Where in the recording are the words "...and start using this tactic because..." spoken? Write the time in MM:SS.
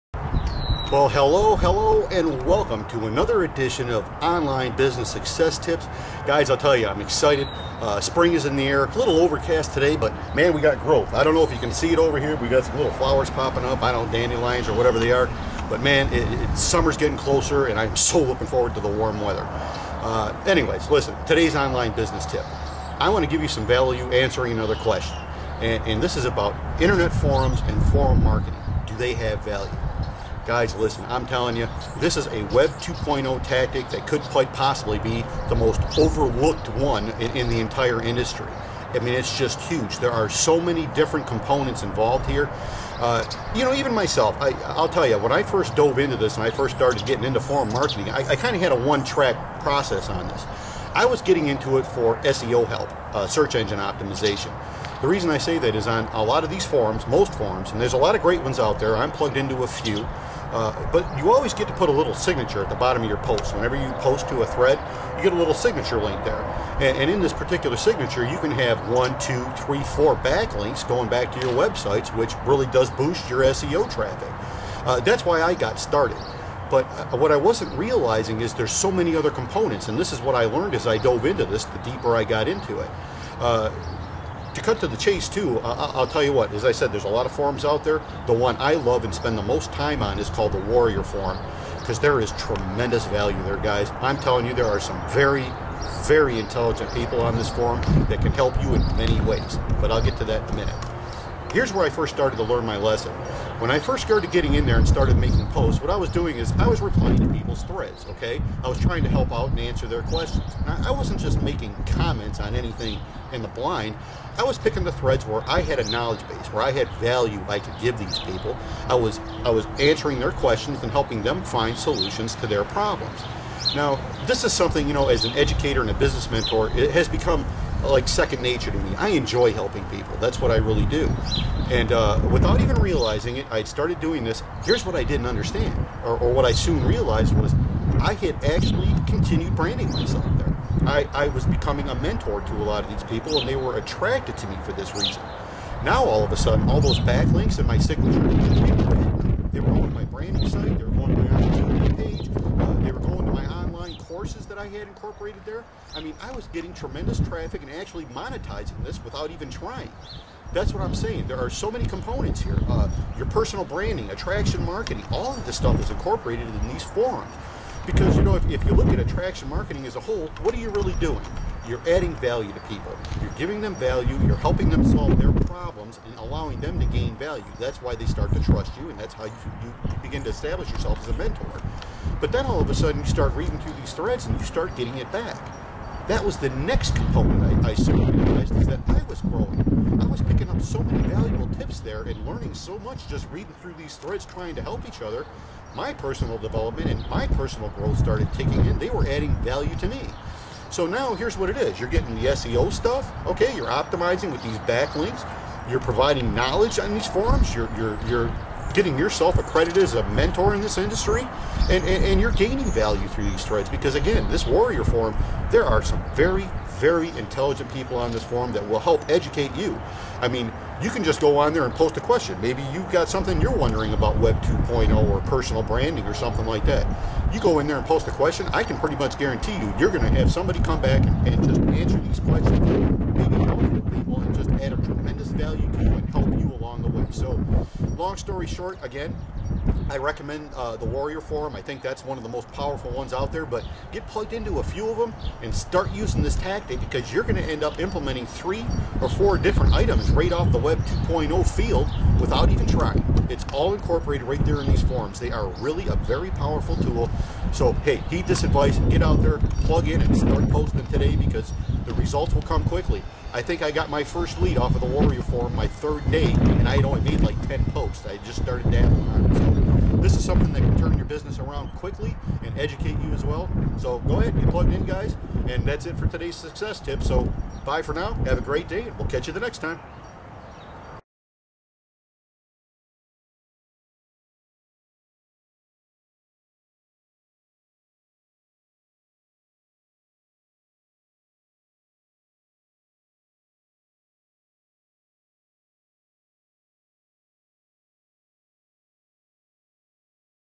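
04:05.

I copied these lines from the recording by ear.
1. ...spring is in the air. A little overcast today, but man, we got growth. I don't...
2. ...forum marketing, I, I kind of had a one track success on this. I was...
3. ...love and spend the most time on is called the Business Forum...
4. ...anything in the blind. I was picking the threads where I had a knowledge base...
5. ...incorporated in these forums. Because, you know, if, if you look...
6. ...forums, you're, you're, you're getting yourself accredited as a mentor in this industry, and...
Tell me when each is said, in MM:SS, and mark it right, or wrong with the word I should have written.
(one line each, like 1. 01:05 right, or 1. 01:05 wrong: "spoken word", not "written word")
1. 00:08 right
2. 00:47 wrong: "process", not "success"
3. 01:28 wrong: "Warrior", not "Business"
4. 01:52 right
5. 02:45 right
6. 03:27 right.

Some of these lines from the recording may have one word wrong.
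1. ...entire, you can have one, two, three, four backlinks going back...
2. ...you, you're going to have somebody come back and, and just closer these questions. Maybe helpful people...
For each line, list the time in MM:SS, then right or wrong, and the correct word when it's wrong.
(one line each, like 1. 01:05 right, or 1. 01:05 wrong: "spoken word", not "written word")
1. 01:07 wrong: "signature", not "entire"
2. 03:49 wrong: "answer", not "closer".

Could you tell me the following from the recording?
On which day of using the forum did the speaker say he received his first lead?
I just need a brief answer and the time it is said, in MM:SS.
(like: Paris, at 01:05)
third day, at 04:25.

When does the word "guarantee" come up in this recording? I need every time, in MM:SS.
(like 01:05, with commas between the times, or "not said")
03:49.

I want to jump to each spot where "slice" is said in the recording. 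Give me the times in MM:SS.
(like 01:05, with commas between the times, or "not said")
not said.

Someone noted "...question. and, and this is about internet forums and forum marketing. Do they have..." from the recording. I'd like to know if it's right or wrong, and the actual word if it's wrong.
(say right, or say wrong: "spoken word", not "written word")
right.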